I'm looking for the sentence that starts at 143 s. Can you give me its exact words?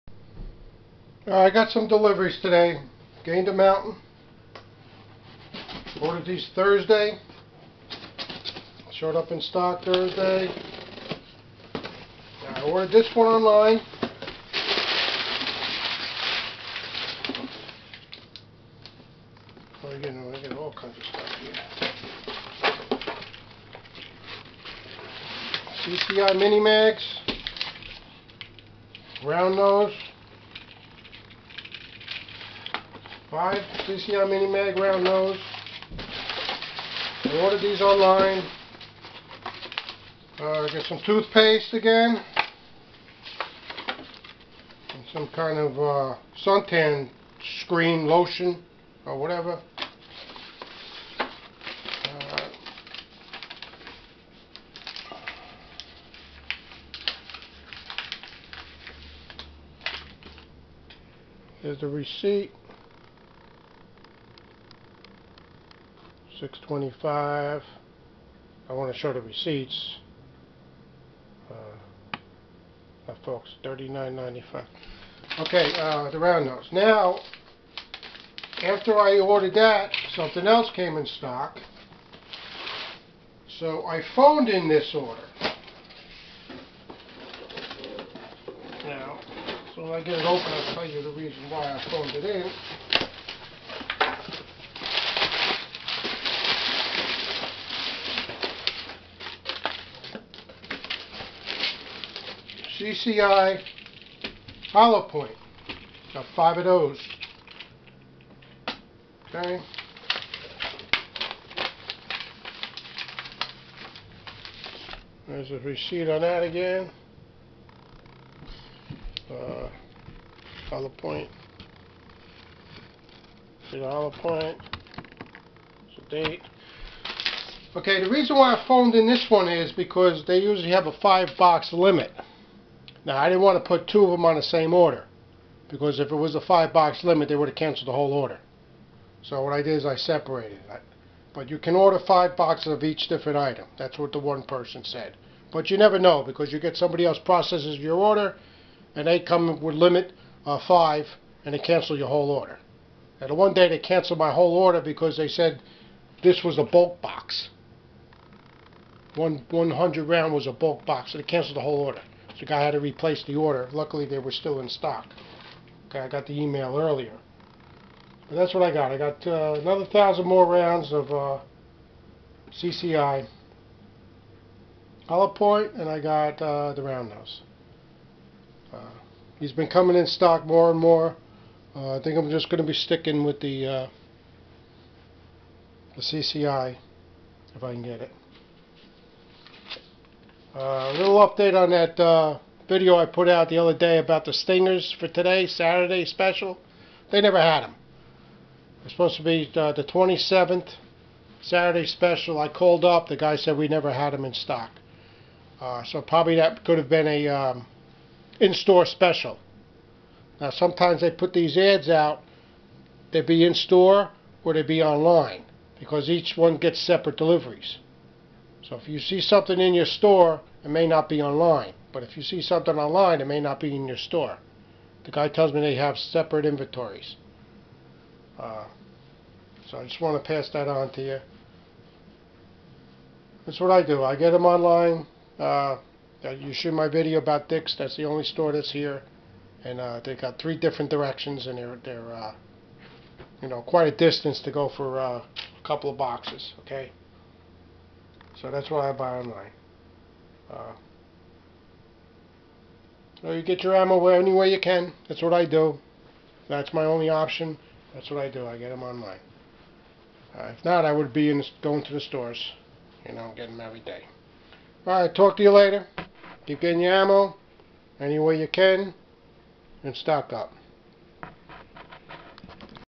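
That's what the one person said.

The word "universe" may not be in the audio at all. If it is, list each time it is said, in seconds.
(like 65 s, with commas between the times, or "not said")
not said.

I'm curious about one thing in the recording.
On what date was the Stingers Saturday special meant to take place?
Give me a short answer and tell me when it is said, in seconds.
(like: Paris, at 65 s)
27th, at 199 s.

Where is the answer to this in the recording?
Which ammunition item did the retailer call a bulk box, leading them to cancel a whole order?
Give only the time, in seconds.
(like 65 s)
159 s.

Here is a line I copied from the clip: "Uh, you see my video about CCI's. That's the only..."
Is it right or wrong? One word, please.
wrong.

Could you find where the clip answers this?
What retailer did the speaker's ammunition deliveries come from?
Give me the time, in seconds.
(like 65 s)
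3 s.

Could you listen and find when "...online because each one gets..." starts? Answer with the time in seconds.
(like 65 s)
214 s.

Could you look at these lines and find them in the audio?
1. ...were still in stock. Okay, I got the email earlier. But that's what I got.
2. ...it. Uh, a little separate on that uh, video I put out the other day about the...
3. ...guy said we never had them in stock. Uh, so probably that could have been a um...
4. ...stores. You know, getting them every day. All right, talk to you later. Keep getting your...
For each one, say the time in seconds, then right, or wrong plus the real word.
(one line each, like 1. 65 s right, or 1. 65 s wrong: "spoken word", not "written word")
1. 164 s right
2. 187 s wrong: "update", not "separate"
3. 203 s right
4. 261 s right.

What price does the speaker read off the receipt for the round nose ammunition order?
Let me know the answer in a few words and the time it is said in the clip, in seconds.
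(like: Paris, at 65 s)
39.95, at 73 s.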